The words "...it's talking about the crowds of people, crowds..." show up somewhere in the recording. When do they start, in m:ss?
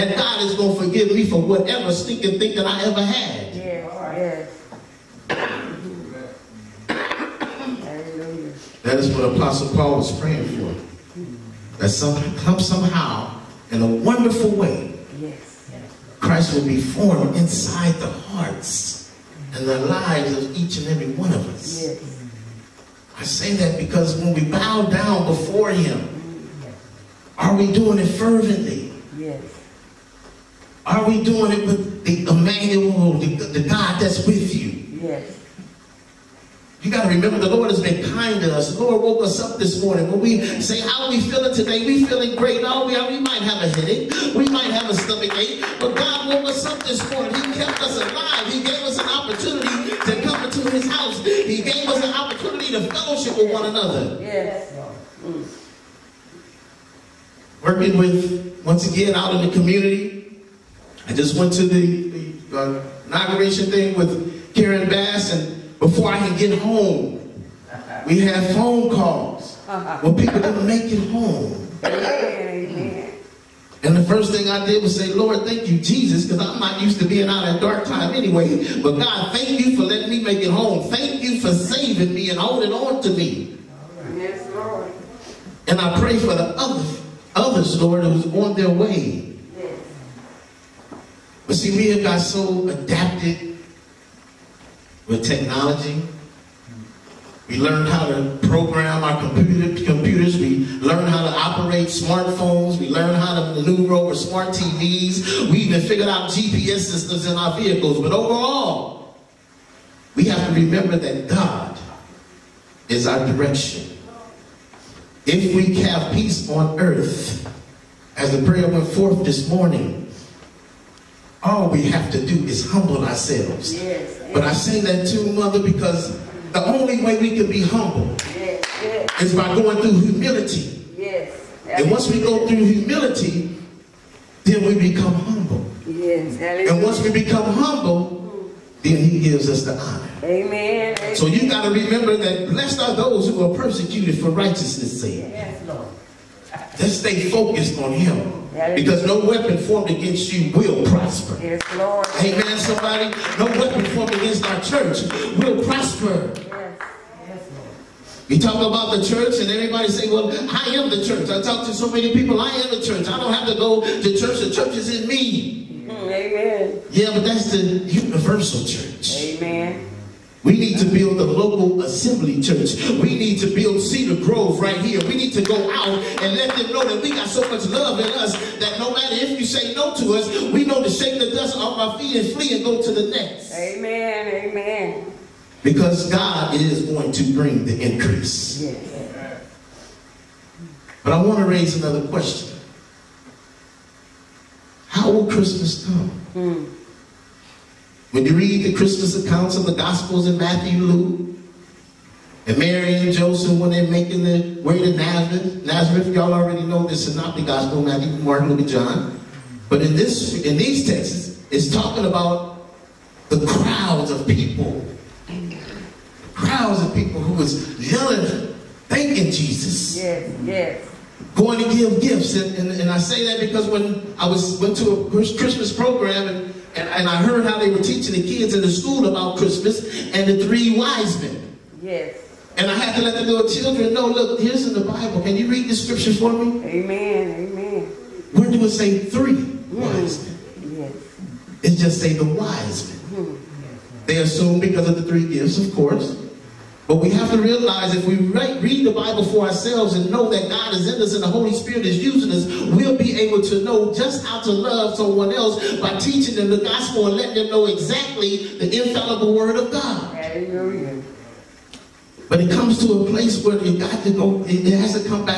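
3:31.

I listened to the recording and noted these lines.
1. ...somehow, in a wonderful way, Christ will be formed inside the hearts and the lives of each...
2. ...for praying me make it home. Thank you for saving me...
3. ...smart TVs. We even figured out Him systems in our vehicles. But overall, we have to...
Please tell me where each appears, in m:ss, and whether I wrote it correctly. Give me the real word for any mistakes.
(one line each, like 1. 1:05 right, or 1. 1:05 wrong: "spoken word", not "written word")
1. 0:12 right
2. 1:19 wrong: "letting", not "praying"
3. 1:44 wrong: "GPS", not "Him".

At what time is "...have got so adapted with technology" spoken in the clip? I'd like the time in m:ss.
1:31.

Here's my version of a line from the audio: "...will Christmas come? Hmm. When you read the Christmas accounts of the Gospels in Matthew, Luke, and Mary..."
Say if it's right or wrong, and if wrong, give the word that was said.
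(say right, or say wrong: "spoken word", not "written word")
right.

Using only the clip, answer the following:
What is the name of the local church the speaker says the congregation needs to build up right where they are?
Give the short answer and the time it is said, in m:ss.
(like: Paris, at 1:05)
Cedar Grove, at 2:53.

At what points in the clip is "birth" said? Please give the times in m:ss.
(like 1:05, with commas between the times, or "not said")
not said.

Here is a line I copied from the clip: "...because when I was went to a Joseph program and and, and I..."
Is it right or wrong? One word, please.
wrong.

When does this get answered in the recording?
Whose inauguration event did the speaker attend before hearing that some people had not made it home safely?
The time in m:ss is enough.
1:04.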